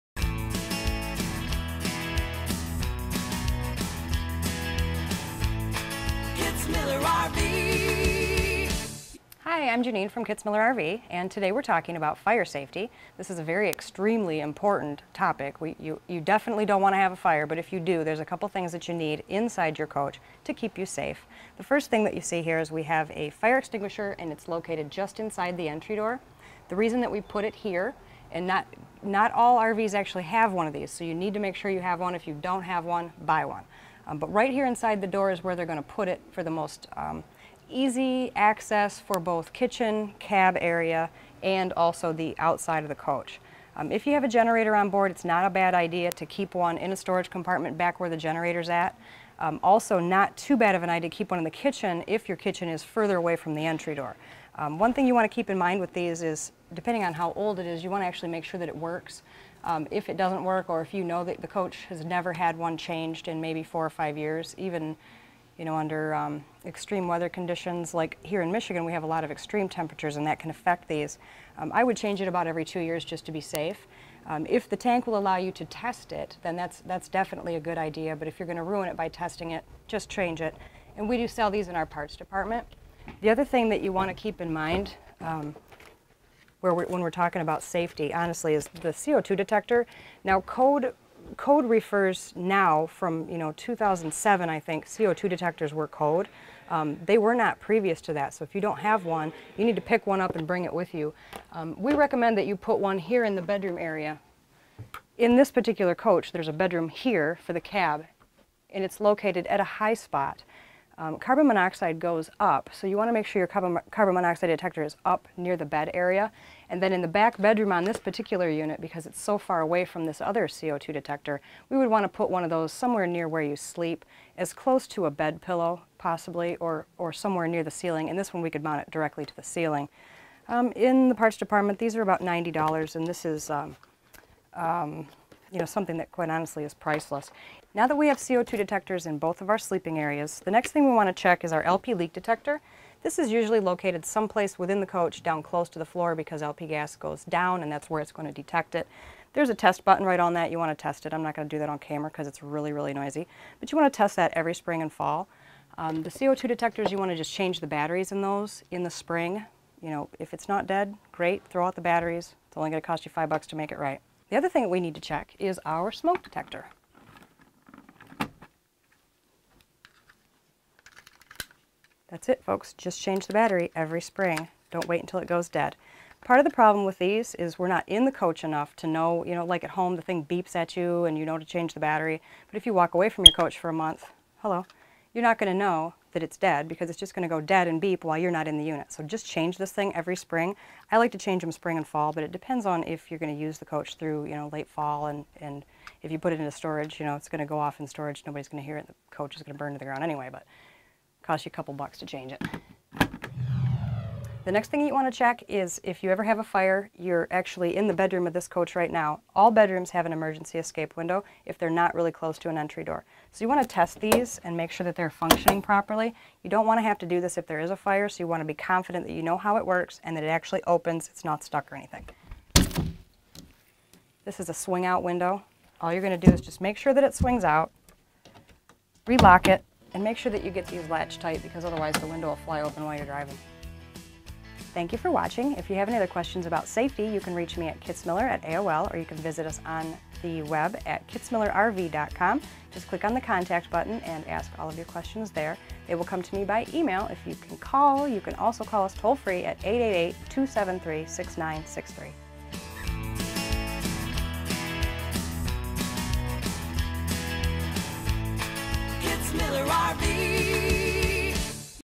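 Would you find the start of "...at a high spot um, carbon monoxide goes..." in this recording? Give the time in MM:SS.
01:49.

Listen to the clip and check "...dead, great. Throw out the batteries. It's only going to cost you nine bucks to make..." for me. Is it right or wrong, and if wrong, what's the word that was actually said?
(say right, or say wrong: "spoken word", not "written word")
wrong: "five", not "nine".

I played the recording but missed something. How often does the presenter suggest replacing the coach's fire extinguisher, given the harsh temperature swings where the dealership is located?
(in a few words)
every 2 years.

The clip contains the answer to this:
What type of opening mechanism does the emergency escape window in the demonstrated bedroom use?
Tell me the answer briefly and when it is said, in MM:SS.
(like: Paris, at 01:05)
Swing out, at 03:44.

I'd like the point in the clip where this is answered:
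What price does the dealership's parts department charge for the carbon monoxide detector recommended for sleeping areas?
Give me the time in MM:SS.
02:12.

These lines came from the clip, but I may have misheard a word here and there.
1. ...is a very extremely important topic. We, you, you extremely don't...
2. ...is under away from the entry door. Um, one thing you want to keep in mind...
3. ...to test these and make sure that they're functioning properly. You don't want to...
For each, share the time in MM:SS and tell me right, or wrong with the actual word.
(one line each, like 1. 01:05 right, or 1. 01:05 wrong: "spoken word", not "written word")
1. 00:13 wrong: "definitely", not "extremely"
2. 00:52 wrong: "further", not "under"
3. 03:33 right.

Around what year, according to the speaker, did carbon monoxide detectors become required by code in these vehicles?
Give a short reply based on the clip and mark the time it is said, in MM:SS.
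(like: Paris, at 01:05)
2007, at 01:33.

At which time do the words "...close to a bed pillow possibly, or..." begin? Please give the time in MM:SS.
02:04.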